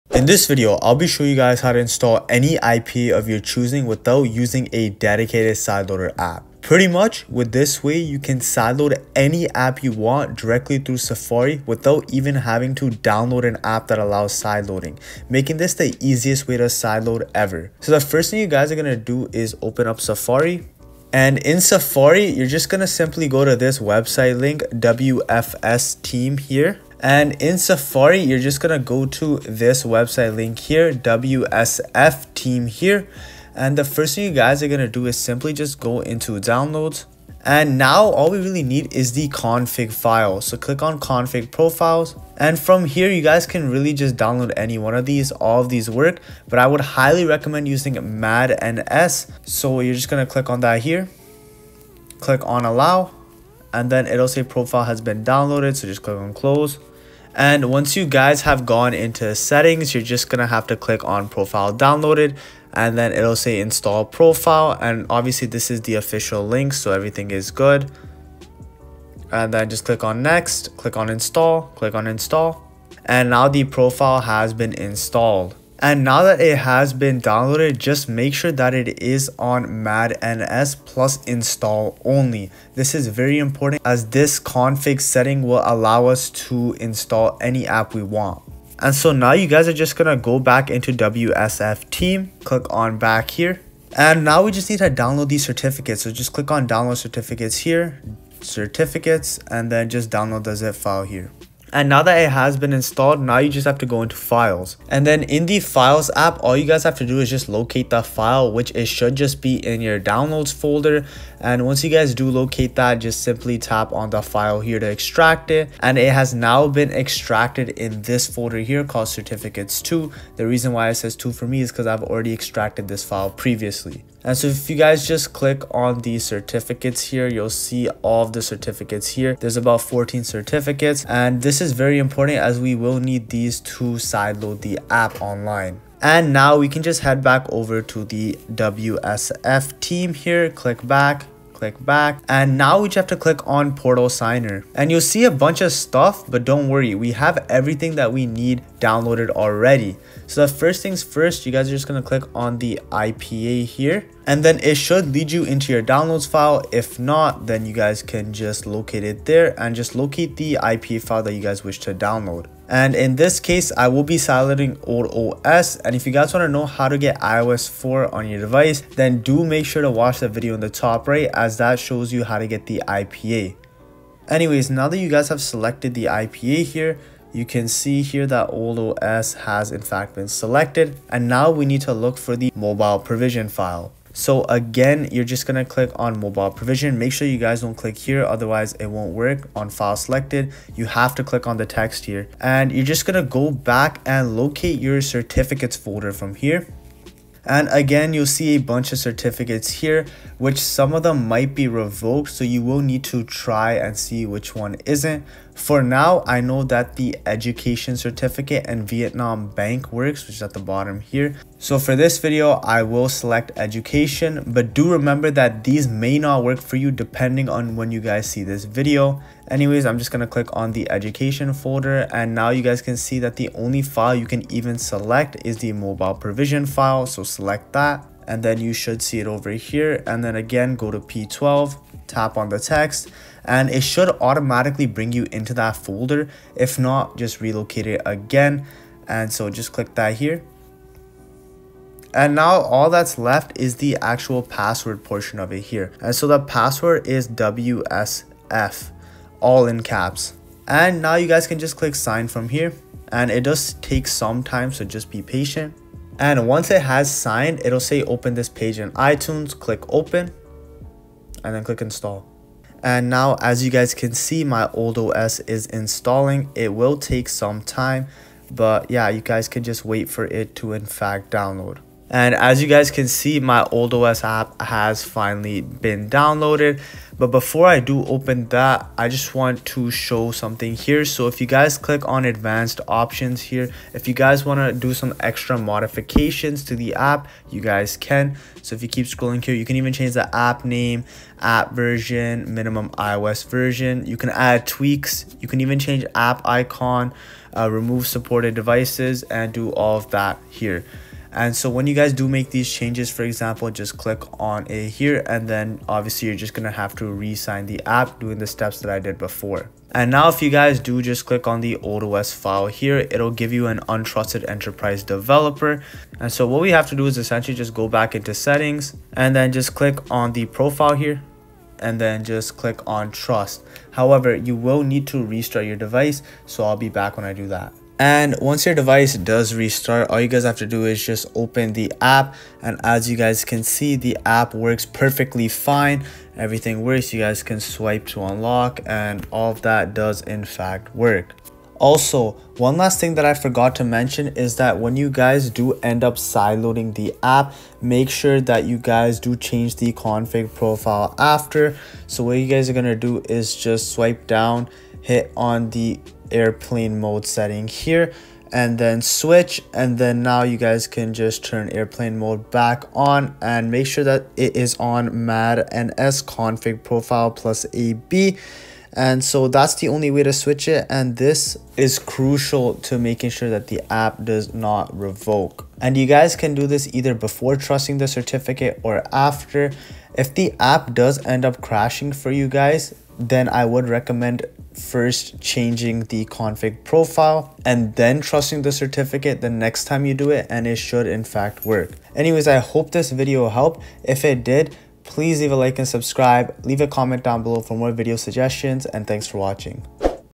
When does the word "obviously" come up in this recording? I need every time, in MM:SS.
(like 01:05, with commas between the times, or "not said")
01:05, 05:05.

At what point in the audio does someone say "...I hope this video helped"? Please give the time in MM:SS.
06:32.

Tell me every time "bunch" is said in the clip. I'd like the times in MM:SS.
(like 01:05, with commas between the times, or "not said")
02:25, 03:18.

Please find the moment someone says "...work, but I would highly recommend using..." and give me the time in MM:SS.
00:45.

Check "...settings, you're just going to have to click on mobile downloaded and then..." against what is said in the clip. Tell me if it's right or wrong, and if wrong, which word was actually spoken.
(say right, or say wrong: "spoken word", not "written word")
wrong: "profile", not "mobile".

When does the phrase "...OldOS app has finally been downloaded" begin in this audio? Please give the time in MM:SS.
04:33.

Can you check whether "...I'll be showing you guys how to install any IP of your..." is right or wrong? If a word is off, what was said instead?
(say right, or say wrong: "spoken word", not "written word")
right.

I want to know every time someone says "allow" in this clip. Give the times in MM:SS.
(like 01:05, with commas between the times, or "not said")
00:13, 00:52, 01:25.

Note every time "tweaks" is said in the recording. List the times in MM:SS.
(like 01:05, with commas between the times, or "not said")
04:54.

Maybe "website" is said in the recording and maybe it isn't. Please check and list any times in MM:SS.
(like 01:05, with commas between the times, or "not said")
00:23, 00:29.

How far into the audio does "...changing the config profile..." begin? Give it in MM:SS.
06:25.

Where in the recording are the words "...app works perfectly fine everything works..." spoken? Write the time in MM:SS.
05:34.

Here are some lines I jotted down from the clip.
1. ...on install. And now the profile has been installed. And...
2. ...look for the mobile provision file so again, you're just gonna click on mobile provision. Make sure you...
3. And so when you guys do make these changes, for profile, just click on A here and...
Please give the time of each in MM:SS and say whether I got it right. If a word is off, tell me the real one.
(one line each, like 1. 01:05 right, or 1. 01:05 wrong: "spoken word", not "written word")
1. 01:11 right
2. 03:01 right
3. 05:01 wrong: "example", not "profile".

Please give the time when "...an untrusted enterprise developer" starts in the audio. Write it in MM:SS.
05:13.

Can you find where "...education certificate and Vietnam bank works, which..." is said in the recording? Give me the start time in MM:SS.
03:27.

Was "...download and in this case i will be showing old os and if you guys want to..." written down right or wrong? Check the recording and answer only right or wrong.
wrong.